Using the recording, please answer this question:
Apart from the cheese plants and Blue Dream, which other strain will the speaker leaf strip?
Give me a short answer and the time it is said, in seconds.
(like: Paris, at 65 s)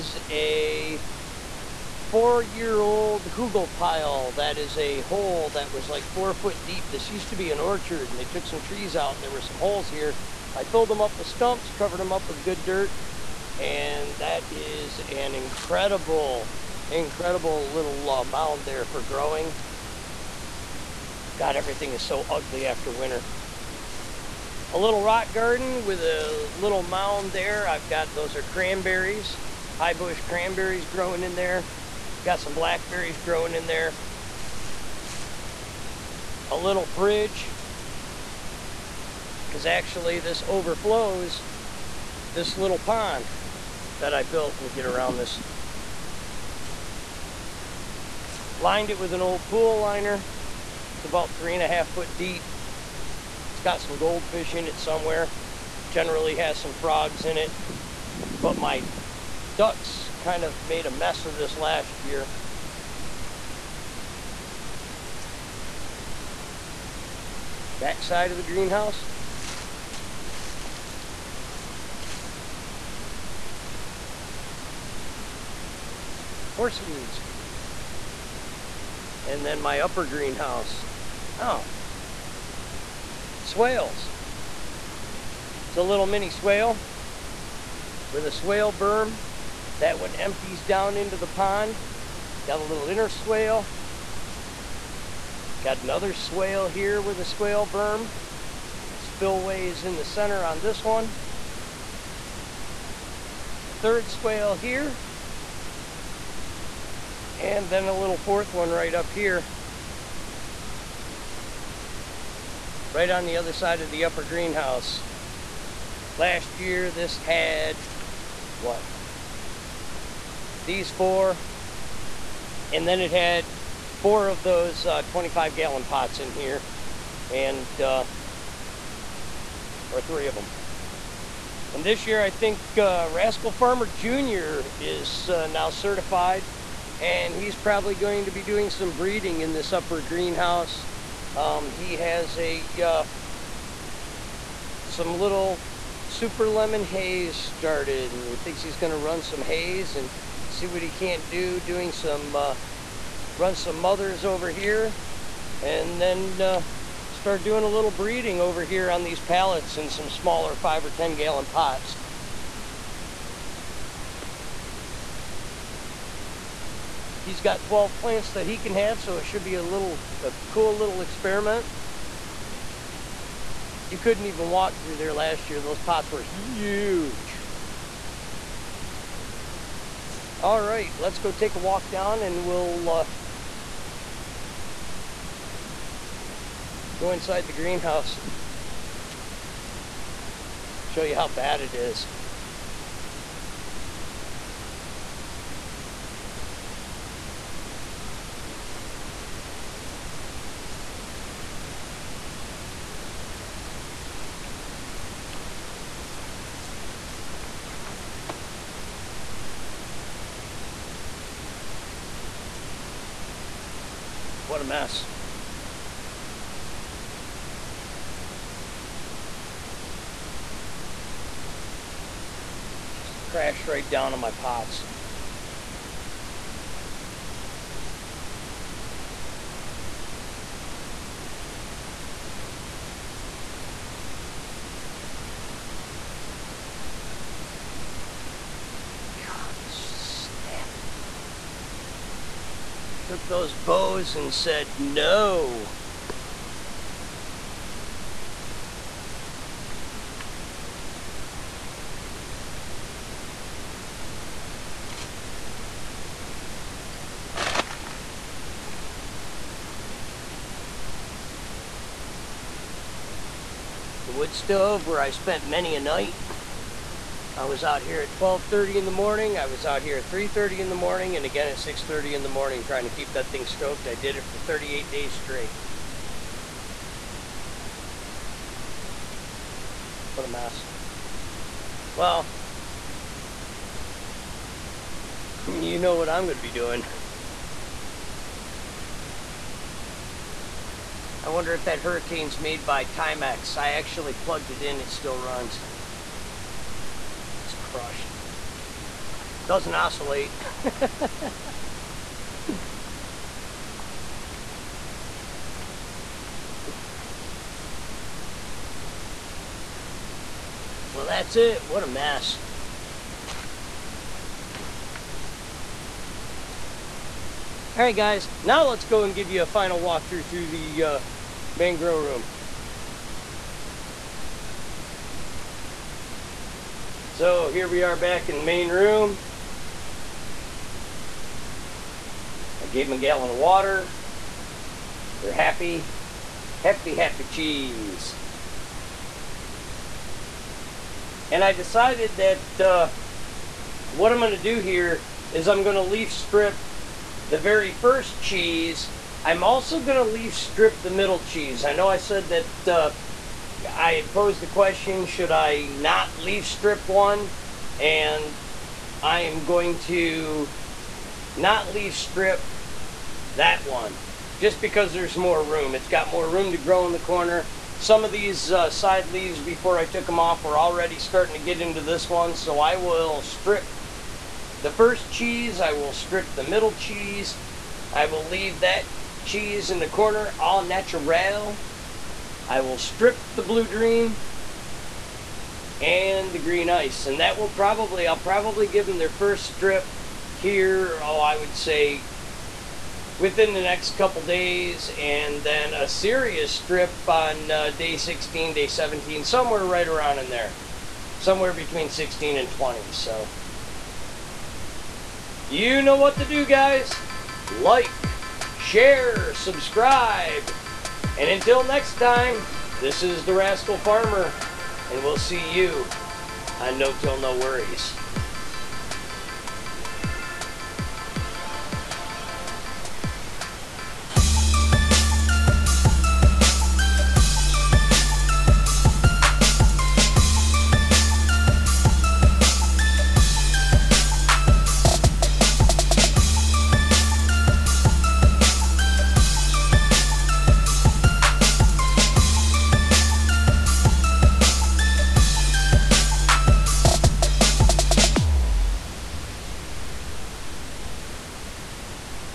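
Green Ice, at 386 s.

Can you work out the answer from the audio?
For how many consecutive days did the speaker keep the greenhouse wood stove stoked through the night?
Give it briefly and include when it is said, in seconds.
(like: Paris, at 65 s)
38, at 274 s.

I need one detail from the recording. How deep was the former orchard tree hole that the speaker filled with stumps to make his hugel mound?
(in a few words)
4 foot.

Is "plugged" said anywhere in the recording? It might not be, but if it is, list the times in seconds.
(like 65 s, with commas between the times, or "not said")
294 s.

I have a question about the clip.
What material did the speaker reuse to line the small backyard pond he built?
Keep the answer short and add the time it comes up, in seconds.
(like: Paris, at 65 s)
An old pool liner, at 49 s.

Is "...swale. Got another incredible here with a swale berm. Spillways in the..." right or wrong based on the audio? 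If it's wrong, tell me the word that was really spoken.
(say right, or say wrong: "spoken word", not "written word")
wrong: "swale", not "incredible".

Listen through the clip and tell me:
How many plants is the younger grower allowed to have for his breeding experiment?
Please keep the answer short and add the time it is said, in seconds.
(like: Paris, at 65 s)
12, at 167 s.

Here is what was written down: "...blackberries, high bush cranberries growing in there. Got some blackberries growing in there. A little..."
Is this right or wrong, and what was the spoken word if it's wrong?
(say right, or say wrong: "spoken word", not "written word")
wrong: "cranberries", not "blackberries".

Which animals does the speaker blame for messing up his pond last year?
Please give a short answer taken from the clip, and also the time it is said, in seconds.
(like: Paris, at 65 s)
Ducks, at 59 s.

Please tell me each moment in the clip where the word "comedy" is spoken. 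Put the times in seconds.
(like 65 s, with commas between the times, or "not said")
not said.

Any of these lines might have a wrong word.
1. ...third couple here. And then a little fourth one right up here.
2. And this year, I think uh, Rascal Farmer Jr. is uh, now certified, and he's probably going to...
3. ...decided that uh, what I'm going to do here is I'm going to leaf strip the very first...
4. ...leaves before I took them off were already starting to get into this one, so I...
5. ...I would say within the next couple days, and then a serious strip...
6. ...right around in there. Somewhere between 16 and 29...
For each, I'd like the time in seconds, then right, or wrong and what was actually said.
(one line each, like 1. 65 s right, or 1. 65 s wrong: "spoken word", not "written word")
1. 103 s wrong: "swale", not "couple"
2. 131 s right
3. 341 s right
4. 369 s right
5. 391 s right
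6. 399 s wrong: "20", not "29".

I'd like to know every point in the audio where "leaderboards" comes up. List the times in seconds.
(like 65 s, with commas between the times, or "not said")
not said.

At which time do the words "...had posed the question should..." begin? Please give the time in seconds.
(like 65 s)
353 s.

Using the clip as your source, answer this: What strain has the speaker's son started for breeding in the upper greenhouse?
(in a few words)
Super Lemon Haze.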